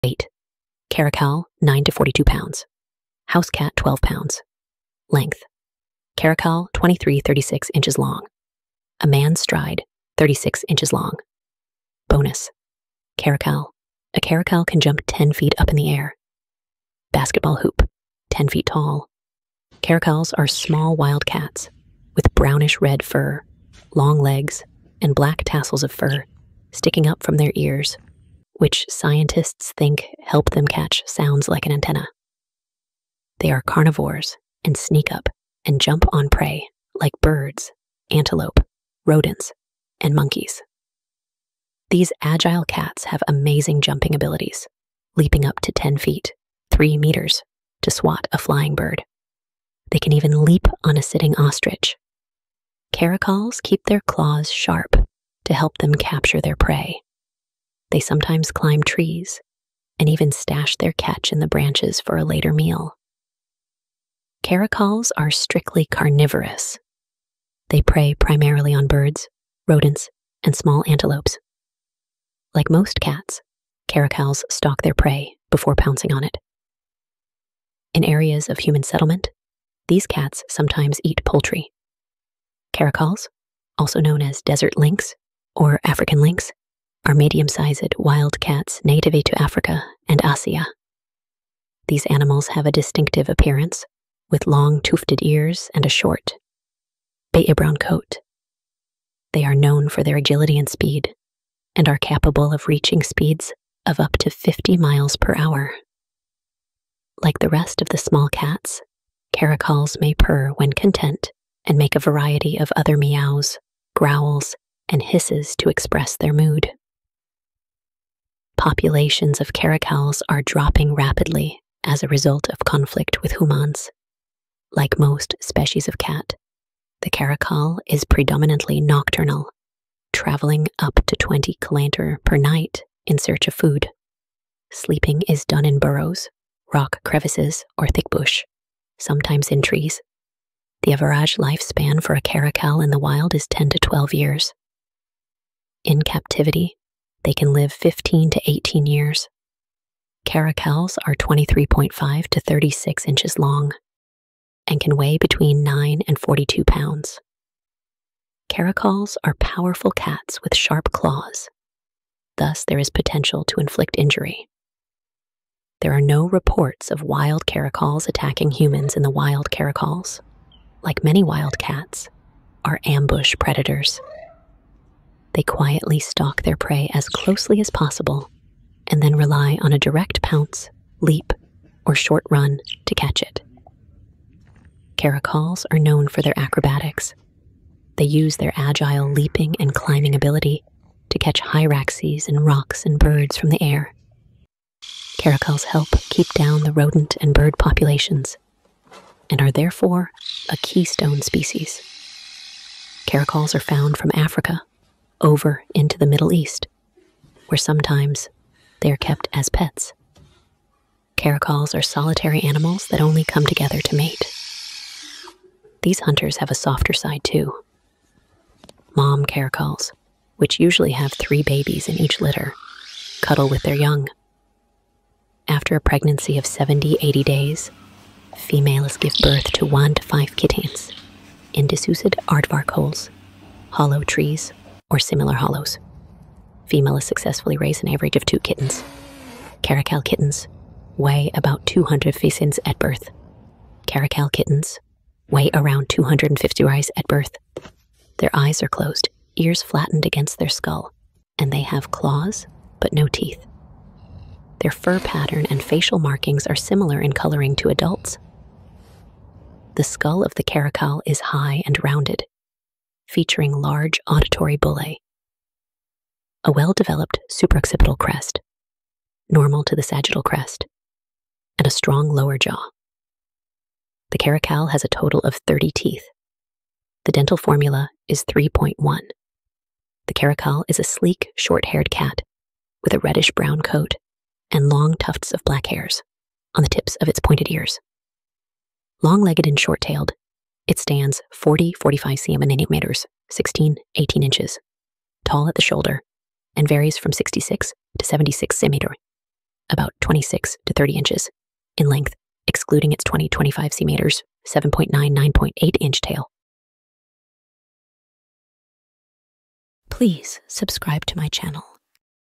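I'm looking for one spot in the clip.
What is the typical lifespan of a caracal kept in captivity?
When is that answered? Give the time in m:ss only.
2:27.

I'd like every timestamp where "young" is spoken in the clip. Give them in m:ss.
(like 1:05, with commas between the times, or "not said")
3:43.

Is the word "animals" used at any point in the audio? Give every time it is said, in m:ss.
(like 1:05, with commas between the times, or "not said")
1:32, 3:32.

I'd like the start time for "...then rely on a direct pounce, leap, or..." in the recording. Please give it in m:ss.
2:59.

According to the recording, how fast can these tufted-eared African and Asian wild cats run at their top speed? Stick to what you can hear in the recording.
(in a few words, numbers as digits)
50 miles per hour.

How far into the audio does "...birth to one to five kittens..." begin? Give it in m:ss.
3:49.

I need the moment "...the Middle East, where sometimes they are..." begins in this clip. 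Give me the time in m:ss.
3:25.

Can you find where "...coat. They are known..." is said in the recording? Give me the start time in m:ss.
1:37.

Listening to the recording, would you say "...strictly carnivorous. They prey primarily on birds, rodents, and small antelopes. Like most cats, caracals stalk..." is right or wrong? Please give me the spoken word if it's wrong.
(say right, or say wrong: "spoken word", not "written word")
right.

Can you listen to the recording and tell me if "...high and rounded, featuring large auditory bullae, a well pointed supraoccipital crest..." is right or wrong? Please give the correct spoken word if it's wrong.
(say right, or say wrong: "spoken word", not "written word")
wrong: "developed", not "pointed".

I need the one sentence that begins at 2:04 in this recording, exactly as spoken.
Like most species of cat, the caracal is predominantly nocturnal, traveling up to 20 km per night in search of food.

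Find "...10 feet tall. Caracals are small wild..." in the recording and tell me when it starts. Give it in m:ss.
0:18.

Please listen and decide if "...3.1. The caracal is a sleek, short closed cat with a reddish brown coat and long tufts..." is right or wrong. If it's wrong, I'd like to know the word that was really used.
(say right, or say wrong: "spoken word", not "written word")
wrong: "haired", not "closed".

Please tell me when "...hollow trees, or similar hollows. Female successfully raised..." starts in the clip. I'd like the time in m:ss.
3:53.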